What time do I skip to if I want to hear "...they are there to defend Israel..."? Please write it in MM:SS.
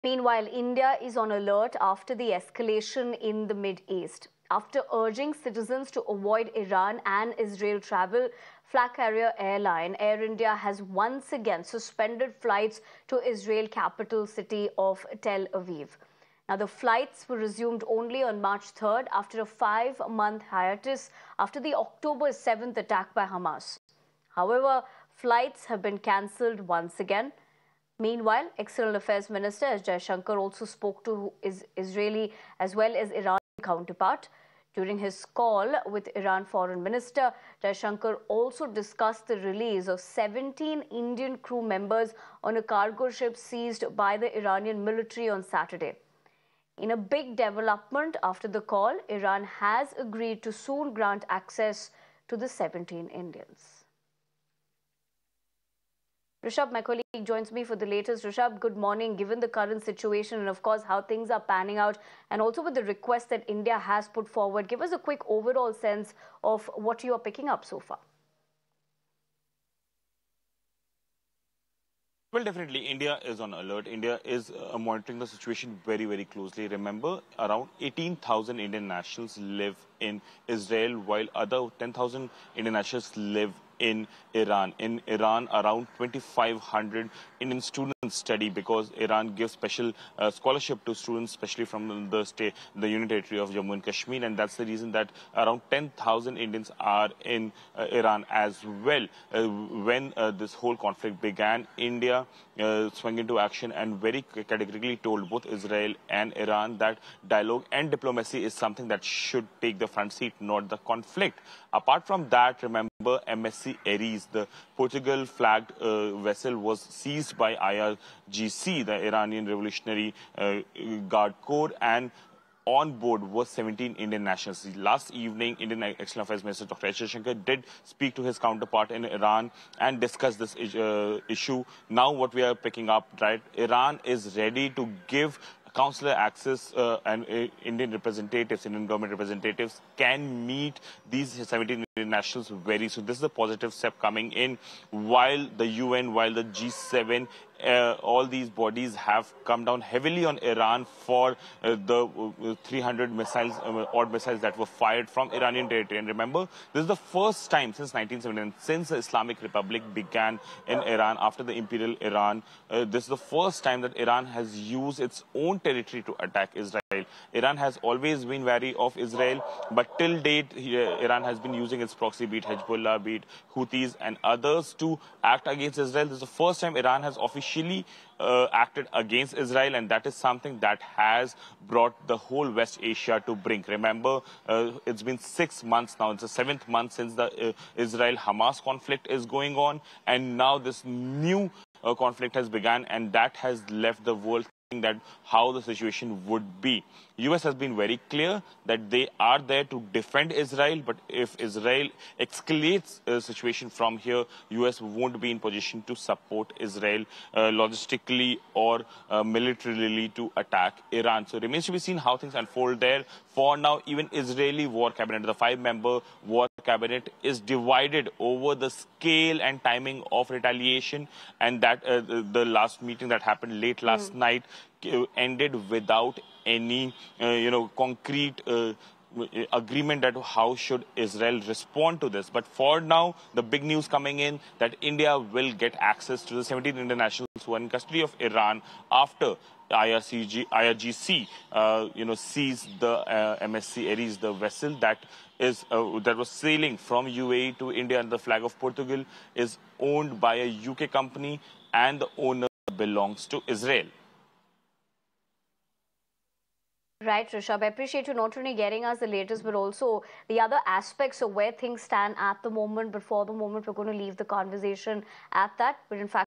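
03:18.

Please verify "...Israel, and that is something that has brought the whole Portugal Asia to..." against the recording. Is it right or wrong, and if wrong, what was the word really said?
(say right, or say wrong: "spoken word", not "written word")
wrong: "West", not "Portugal".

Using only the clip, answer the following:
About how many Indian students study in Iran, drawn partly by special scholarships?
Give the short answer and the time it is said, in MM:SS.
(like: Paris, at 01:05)
2,500, at 01:25.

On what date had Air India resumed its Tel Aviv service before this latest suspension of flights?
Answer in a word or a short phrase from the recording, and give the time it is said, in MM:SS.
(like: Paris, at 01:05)
March 3rd, at 00:18.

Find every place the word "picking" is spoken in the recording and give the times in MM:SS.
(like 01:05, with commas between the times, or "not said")
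01:07, 02:12.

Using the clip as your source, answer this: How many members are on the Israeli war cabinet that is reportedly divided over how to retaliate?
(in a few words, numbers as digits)
5.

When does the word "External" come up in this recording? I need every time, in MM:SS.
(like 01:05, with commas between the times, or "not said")
00:28, 02:05.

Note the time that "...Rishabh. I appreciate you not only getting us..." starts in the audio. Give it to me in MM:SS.
04:17.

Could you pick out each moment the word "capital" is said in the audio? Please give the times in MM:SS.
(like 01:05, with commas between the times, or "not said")
00:13.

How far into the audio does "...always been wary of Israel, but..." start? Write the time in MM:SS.
02:47.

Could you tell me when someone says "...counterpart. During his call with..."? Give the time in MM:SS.
00:33.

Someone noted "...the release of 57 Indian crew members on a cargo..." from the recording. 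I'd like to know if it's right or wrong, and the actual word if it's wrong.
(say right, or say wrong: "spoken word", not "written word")
wrong: "17", not "57".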